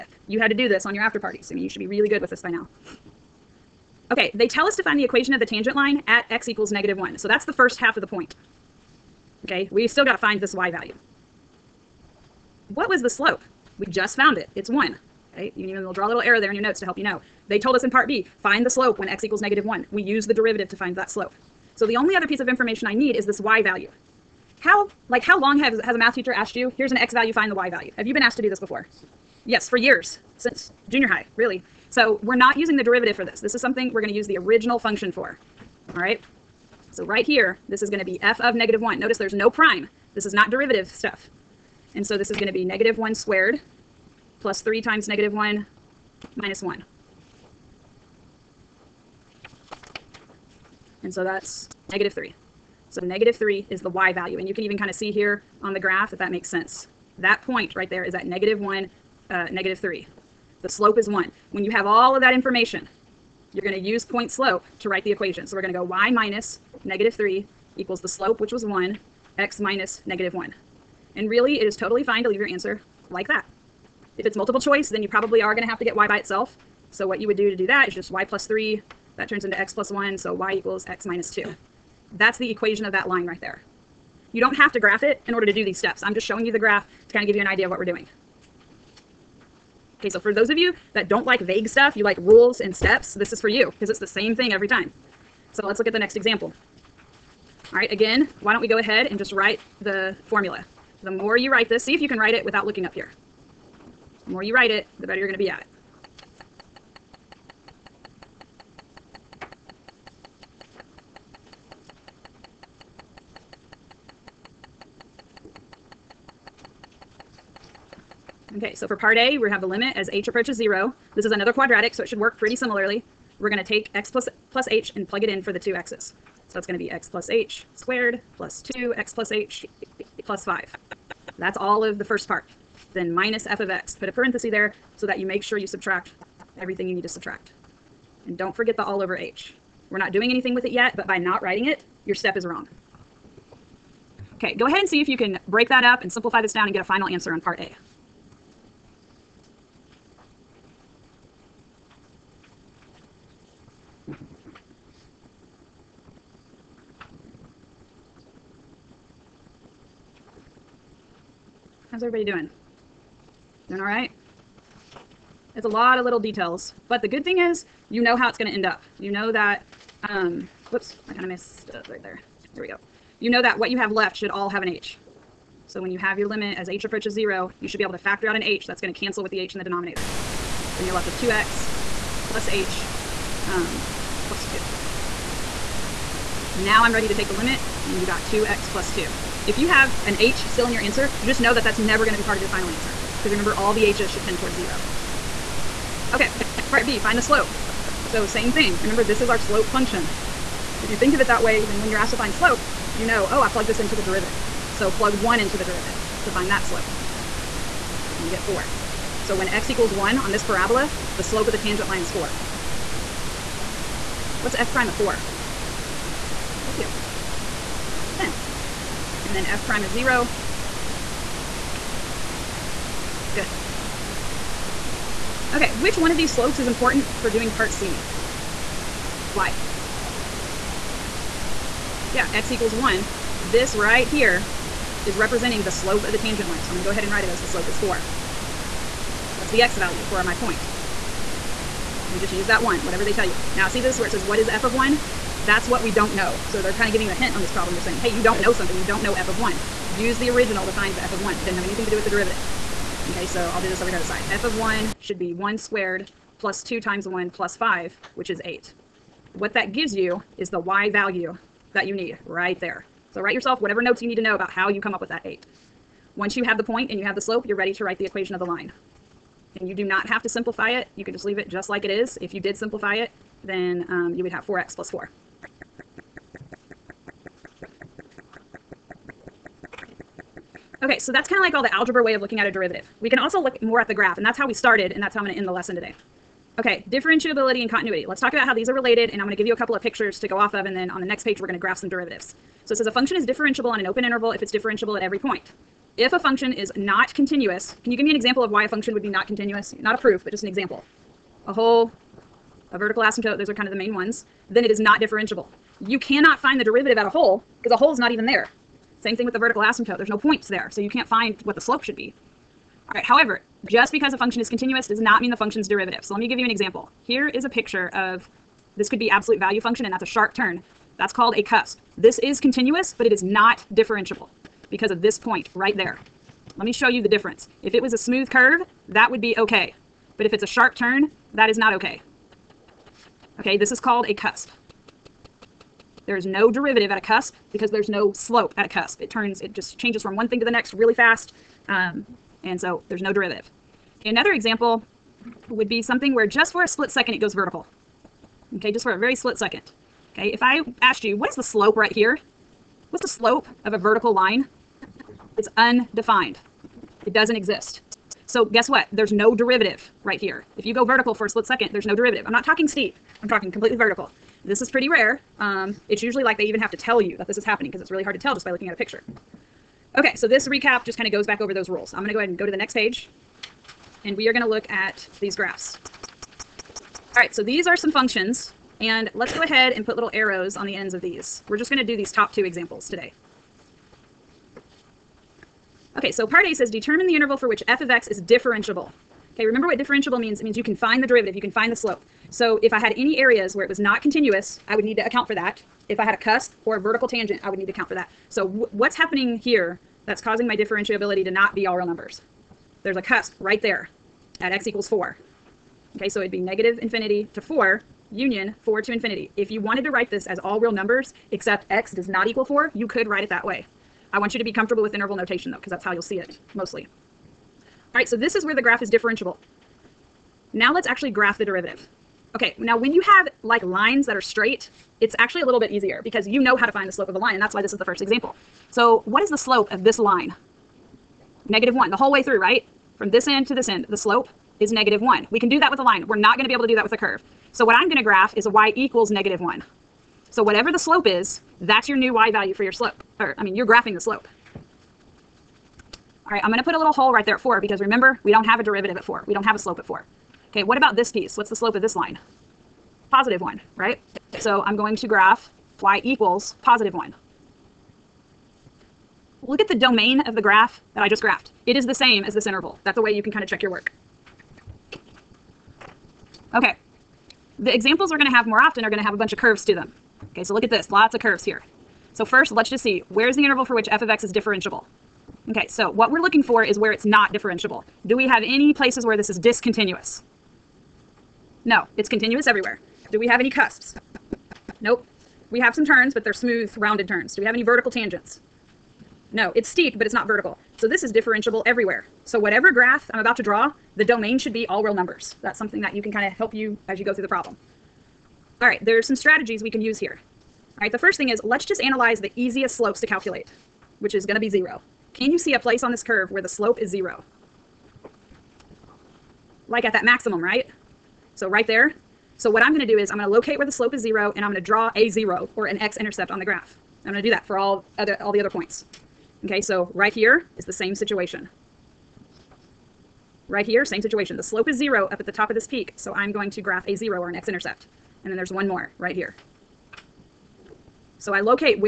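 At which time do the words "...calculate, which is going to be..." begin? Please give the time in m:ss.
8:23.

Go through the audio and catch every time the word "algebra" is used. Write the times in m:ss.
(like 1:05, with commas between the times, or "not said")
4:41.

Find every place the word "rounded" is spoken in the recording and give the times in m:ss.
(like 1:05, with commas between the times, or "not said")
8:06.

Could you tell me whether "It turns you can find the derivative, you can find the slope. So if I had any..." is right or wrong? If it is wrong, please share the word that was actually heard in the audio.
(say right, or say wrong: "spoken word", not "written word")
wrong: "means", not "turns".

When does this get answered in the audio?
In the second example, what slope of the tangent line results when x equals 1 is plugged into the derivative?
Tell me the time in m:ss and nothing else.
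3:28.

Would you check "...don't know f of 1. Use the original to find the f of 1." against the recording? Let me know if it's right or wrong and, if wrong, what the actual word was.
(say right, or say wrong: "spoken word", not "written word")
right.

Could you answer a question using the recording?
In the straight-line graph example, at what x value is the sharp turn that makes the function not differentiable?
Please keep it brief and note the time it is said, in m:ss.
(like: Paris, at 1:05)
4, at 6:44.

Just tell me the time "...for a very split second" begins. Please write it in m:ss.
5:48.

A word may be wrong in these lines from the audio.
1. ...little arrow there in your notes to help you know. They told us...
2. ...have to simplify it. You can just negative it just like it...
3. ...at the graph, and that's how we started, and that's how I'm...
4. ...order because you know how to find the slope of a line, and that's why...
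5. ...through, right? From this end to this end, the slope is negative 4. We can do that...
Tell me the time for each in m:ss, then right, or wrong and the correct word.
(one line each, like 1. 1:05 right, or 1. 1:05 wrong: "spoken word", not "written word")
1. 0:16 right
2. 4:30 wrong: "leave", not "negative"
3. 4:43 right
4. 7:05 wrong: "easier", not "order"
5. 7:12 wrong: "1", not "4".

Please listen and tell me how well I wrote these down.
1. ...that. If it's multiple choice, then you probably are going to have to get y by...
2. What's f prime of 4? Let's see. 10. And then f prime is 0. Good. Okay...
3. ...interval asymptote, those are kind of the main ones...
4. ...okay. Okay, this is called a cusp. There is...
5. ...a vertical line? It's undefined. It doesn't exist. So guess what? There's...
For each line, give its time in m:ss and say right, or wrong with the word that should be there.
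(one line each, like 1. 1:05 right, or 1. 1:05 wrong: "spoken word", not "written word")
1. 1:13 right
2. 3:34 right
3. 5:02 wrong: "vertical", not "interval"
4. 5:31 right
5. 5:53 right.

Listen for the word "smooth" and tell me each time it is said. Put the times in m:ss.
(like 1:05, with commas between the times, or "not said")
5:27, 8:06.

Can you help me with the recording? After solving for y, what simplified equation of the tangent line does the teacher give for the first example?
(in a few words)
y = x - 2.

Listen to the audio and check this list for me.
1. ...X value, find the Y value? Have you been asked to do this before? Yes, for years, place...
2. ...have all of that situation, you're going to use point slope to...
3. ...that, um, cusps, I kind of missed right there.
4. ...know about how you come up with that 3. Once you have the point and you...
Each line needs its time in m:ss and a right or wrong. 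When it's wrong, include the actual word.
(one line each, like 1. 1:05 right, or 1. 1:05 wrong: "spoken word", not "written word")
1. 0:26 wrong: "since", not "place"
2. 1:01 wrong: "information", not "situation"
3. 2:49 wrong: "whoops", not "cusps"
4. 4:24 wrong: "8", not "3".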